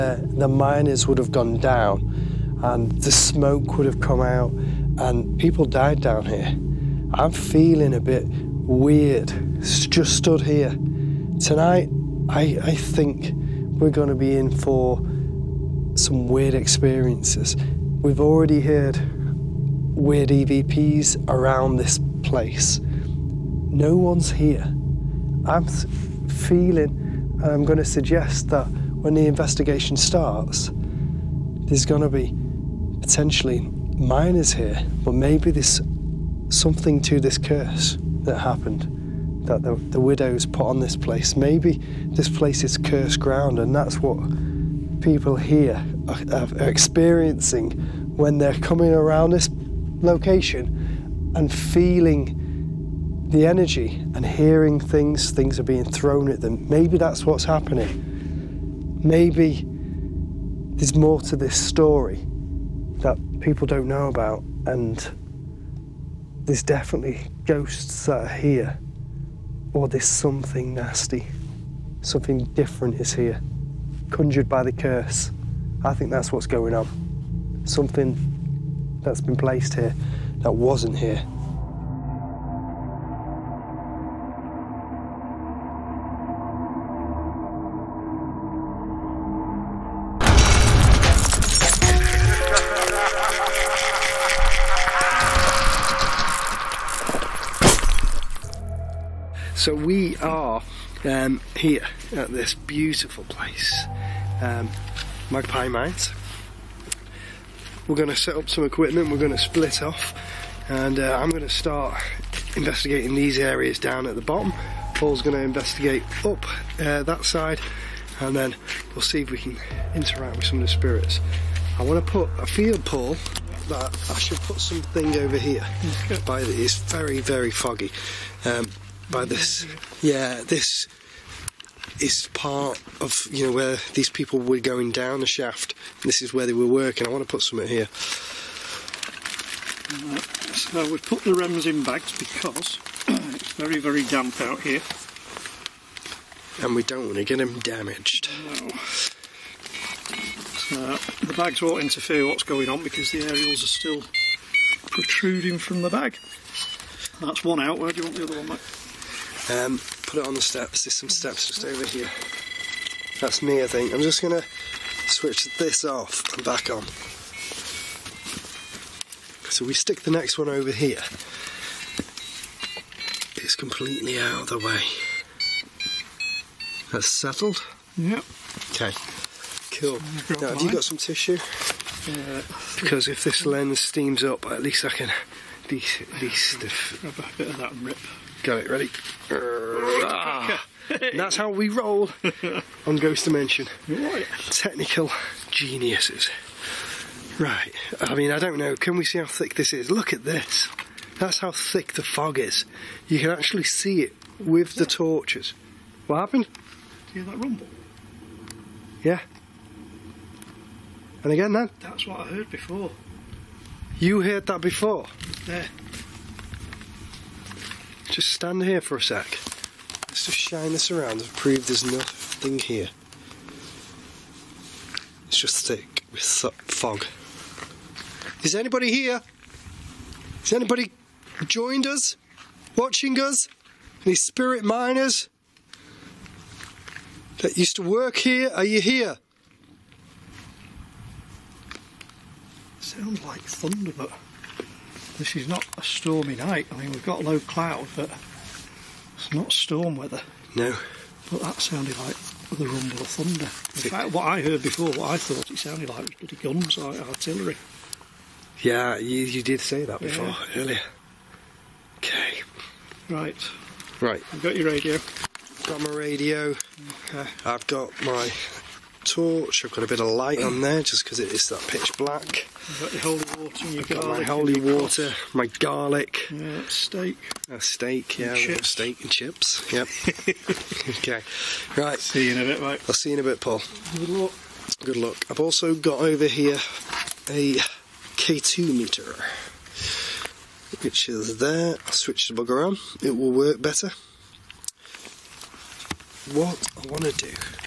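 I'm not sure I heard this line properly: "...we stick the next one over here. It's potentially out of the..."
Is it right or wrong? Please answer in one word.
wrong.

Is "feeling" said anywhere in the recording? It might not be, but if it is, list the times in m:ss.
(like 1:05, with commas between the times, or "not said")
0:07, 0:26, 0:51.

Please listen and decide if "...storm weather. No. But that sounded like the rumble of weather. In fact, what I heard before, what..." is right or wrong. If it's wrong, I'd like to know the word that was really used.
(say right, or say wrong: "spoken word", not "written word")
wrong: "thunder", not "weather".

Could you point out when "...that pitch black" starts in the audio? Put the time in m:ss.
4:31.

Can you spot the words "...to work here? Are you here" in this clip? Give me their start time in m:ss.
3:57.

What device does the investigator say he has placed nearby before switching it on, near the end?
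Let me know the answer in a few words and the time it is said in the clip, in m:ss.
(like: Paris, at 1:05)
K2 meter, at 4:48.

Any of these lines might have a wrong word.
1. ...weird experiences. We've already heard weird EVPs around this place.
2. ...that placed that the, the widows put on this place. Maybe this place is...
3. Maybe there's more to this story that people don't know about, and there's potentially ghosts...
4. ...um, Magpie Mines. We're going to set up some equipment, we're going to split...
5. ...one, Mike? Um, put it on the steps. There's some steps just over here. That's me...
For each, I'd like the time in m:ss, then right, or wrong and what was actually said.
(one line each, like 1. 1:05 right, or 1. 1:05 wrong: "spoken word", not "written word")
1. 0:16 right
2. 0:38 wrong: "happened", not "placed"
3. 0:59 wrong: "definitely", not "potentially"
4. 1:44 right
5. 2:38 right.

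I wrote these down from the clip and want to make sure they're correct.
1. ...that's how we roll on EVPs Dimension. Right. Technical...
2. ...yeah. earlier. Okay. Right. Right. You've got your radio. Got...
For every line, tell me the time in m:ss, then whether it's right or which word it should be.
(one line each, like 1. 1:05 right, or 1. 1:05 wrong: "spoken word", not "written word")
1. 3:11 wrong: "Ghost", not "EVPs"
2. 4:20 right.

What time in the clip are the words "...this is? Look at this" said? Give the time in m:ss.
3:19.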